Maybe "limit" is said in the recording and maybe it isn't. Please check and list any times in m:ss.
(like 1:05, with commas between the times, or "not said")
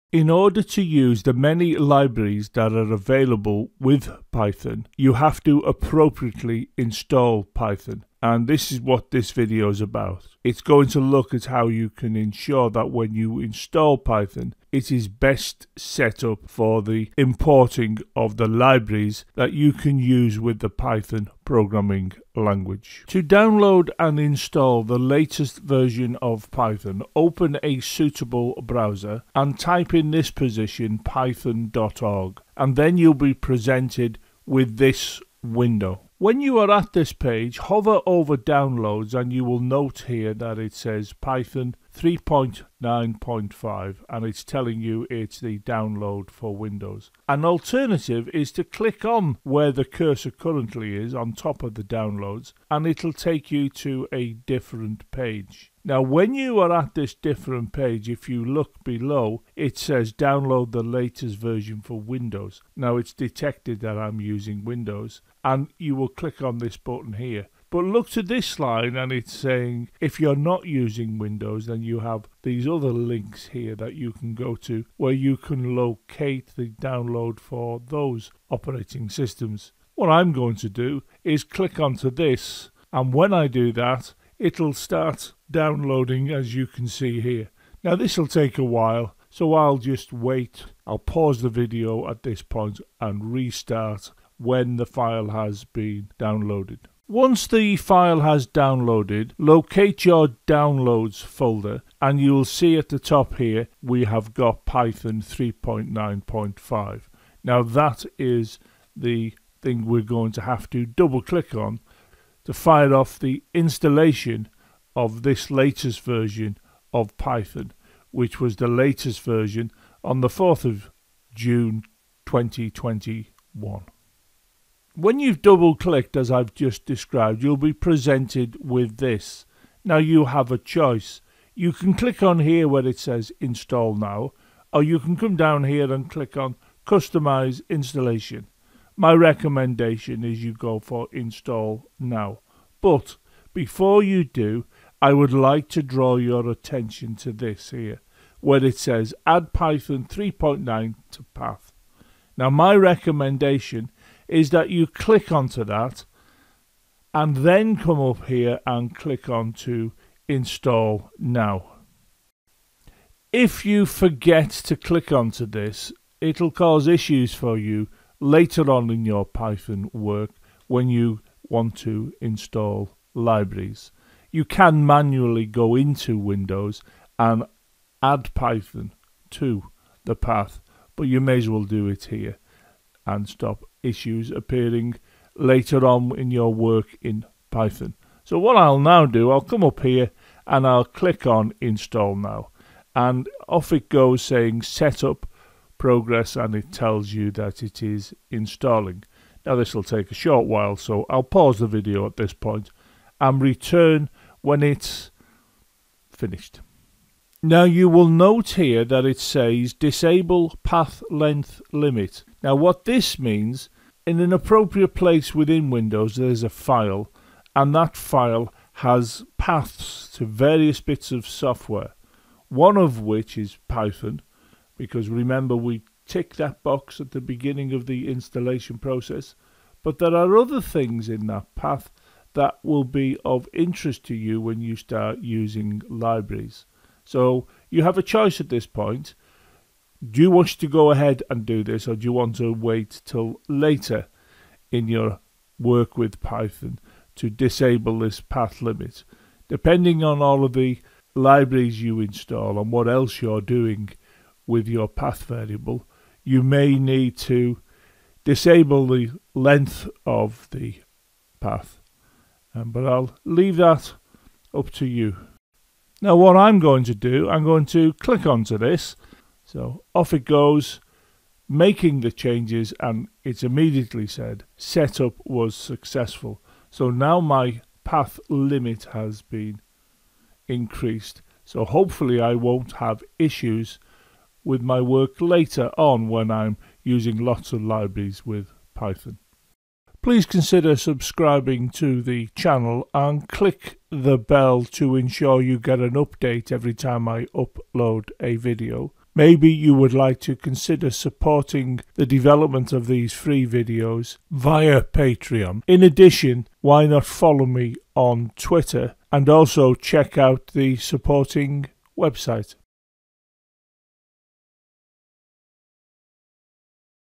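3:31, 4:08, 4:38.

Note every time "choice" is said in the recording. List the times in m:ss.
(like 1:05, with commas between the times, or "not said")
2:10, 3:58.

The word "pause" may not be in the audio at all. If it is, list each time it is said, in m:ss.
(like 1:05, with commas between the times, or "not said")
1:30, 3:21.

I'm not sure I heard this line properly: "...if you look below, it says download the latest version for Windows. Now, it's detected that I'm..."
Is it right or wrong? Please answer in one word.
right.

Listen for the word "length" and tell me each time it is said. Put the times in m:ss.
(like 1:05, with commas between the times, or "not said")
3:31, 4:19.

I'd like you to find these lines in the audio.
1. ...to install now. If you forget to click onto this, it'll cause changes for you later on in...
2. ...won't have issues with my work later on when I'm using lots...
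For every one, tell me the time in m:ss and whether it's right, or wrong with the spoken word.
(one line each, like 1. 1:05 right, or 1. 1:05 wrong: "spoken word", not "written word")
1. 2:39 wrong: "issues", not "changes"
2. 4:42 right.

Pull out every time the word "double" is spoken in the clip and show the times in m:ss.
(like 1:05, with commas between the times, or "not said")
1:50, 2:05.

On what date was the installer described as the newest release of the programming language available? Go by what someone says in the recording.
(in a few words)
4th of June 2021.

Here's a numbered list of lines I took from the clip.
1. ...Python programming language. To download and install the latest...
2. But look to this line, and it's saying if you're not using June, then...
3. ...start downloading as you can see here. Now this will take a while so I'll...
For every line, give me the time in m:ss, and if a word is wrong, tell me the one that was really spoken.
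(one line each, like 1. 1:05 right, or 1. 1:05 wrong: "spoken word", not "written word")
1. 0:20 right
2. 1:07 wrong: "Windows", not "June"
3. 1:24 right.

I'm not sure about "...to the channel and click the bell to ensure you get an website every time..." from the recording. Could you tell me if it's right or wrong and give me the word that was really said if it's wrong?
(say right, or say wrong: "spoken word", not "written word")
wrong: "update", not "website".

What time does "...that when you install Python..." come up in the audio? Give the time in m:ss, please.
0:12.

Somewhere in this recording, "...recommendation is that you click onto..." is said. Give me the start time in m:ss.
2:32.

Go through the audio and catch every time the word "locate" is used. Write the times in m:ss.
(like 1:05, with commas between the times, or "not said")
1:15, 1:39.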